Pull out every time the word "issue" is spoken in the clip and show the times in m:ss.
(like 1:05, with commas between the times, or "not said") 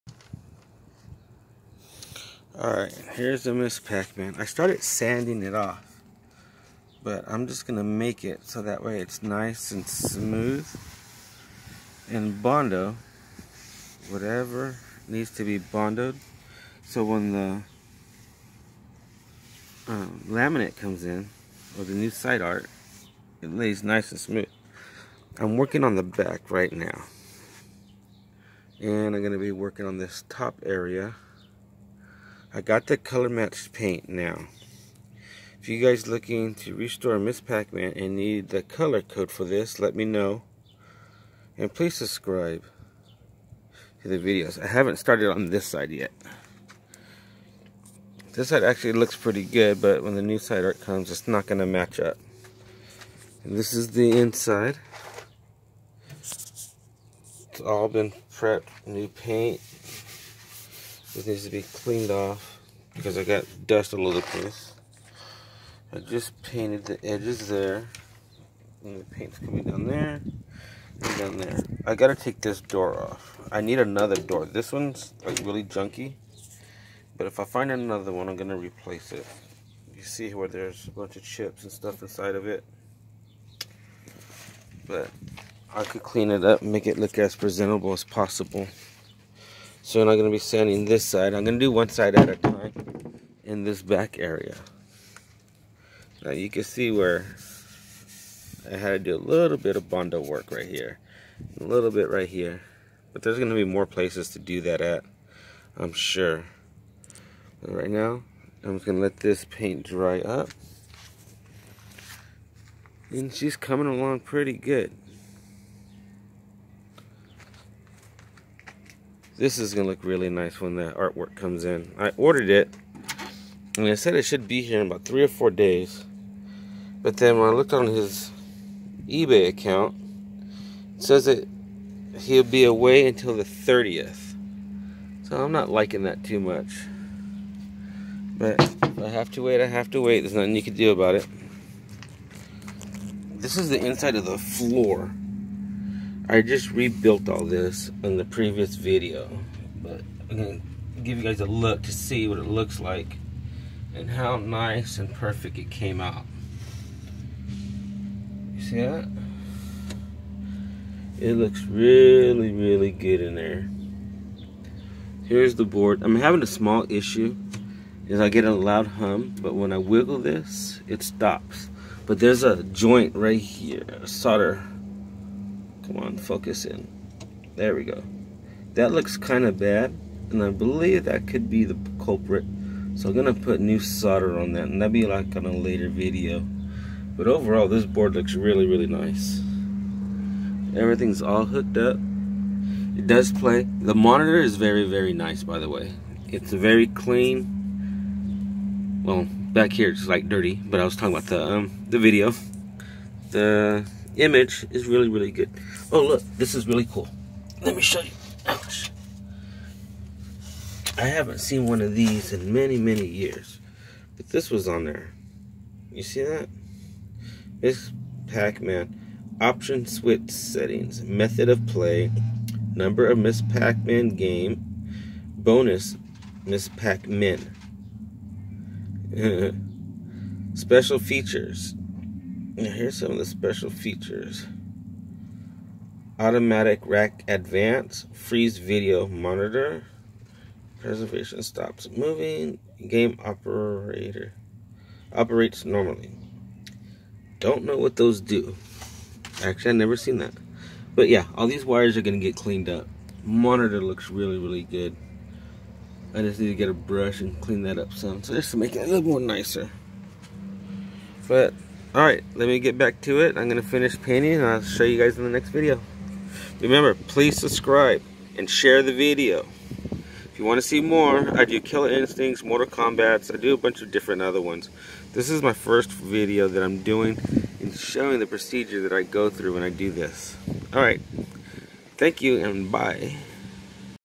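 2:46.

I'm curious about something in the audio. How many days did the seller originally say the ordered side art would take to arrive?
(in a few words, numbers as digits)
3 or 4 days.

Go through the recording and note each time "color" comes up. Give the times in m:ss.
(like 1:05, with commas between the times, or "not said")
0:32, 0:38.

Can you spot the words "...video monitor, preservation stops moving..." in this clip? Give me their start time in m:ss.
3:58.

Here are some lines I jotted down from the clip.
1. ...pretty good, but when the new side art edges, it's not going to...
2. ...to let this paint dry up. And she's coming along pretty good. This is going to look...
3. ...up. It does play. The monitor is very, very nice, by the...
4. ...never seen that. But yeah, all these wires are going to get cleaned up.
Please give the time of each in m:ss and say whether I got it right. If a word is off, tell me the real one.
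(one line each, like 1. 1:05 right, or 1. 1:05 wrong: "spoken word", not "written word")
1. 0:49 wrong: "comes", not "edges"
2. 1:48 right
3. 3:11 right
4. 4:09 right.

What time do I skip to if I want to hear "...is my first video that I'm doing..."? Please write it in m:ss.
4:35.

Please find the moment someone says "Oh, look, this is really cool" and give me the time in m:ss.
3:25.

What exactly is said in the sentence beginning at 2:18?
But I have to wait, I have to wait.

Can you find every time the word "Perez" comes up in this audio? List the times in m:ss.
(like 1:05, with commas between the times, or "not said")
not said.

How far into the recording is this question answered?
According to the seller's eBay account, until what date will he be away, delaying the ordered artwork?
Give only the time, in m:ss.
2:13.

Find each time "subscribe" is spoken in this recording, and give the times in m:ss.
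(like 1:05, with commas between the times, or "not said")
0:41, 4:27.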